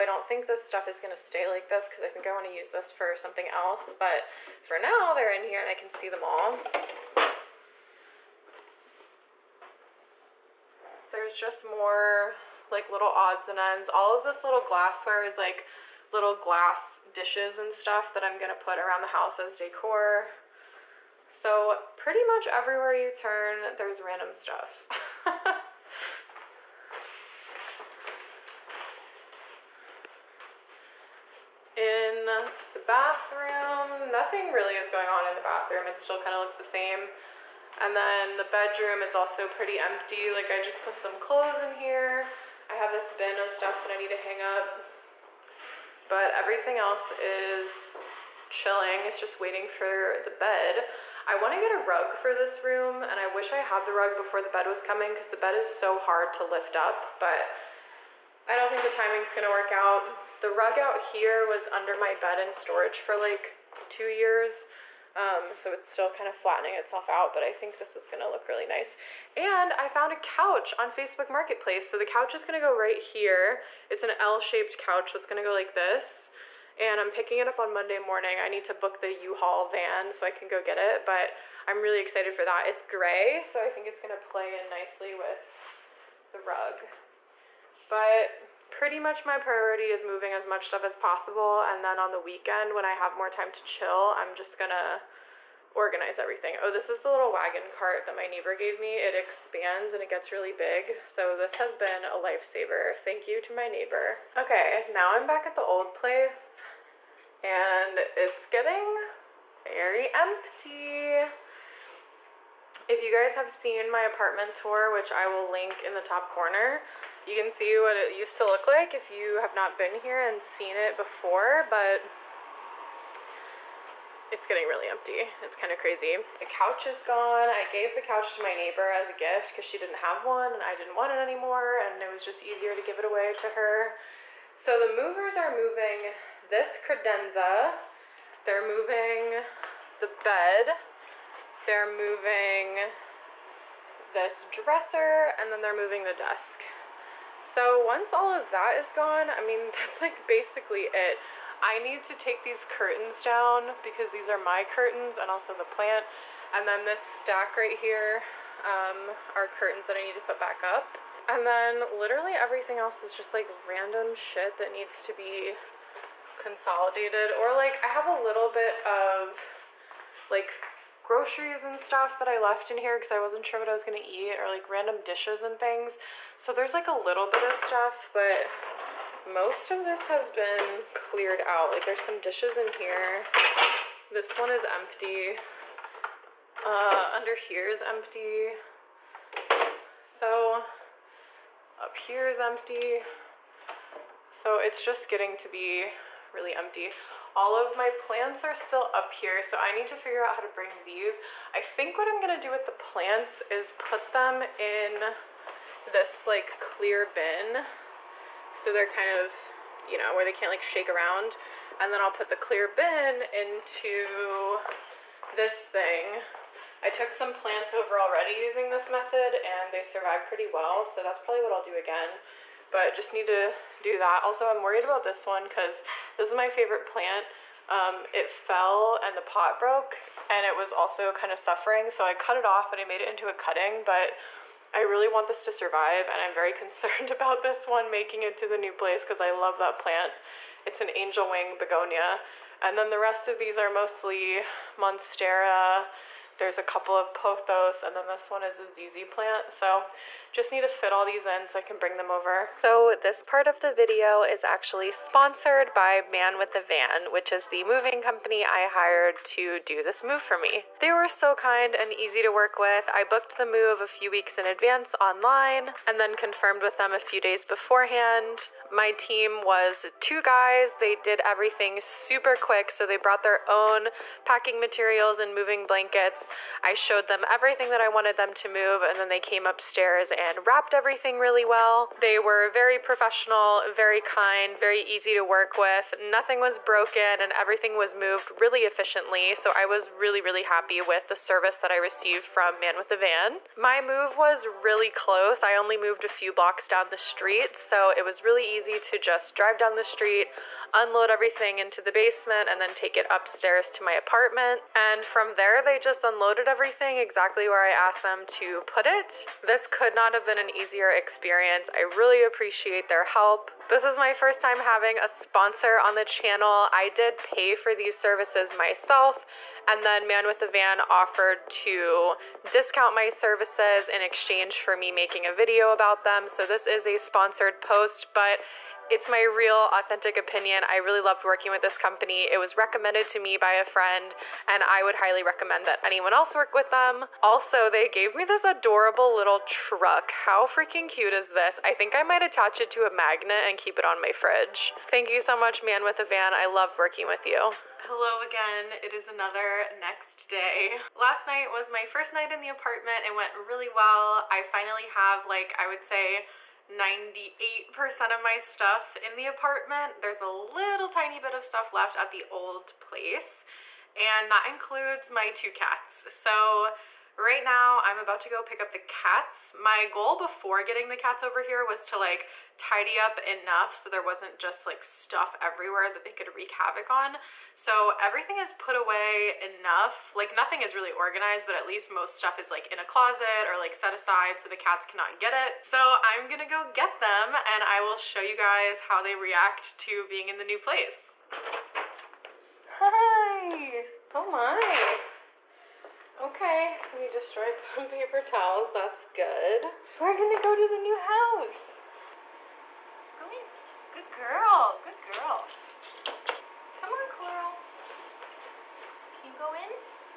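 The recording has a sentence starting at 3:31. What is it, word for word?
And then I'll put the clear bin into this thing.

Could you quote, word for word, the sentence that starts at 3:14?
So it's just getting to be really empty.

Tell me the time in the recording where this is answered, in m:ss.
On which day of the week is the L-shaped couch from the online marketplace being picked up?
1:17.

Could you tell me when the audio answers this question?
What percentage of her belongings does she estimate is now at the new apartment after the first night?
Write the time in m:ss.
5:56.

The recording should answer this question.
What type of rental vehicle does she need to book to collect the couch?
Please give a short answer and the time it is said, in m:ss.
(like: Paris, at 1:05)
U-Haul van, at 1:19.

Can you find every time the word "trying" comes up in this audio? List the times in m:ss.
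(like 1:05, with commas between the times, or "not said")
not said.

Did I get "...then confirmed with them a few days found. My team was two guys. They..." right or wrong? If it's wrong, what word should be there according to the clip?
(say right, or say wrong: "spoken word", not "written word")
wrong: "beforehand", not "found".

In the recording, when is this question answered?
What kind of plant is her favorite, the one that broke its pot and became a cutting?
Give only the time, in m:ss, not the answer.
4:00.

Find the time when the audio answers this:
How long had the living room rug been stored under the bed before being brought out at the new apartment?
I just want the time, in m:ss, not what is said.
1:03.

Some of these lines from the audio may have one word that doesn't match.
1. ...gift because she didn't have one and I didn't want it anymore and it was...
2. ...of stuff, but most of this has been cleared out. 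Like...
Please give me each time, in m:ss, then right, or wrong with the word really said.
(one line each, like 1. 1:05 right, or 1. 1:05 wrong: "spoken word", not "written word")
1. 2:09 right
2. 2:57 right.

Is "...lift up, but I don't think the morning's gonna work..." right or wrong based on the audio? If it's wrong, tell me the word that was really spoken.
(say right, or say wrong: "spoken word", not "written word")
wrong: "timing", not "morning".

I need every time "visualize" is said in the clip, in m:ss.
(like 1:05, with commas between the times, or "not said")
not said.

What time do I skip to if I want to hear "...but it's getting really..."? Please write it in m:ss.
2:01.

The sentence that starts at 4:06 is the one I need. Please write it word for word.
There's a couple of pothos and then this one is a ZZ plant.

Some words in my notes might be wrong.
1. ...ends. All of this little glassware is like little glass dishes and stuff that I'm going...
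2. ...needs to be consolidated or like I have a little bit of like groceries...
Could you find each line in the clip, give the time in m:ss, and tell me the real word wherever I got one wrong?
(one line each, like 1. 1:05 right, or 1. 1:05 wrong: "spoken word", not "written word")
1. 0:13 right
2. 2:44 right.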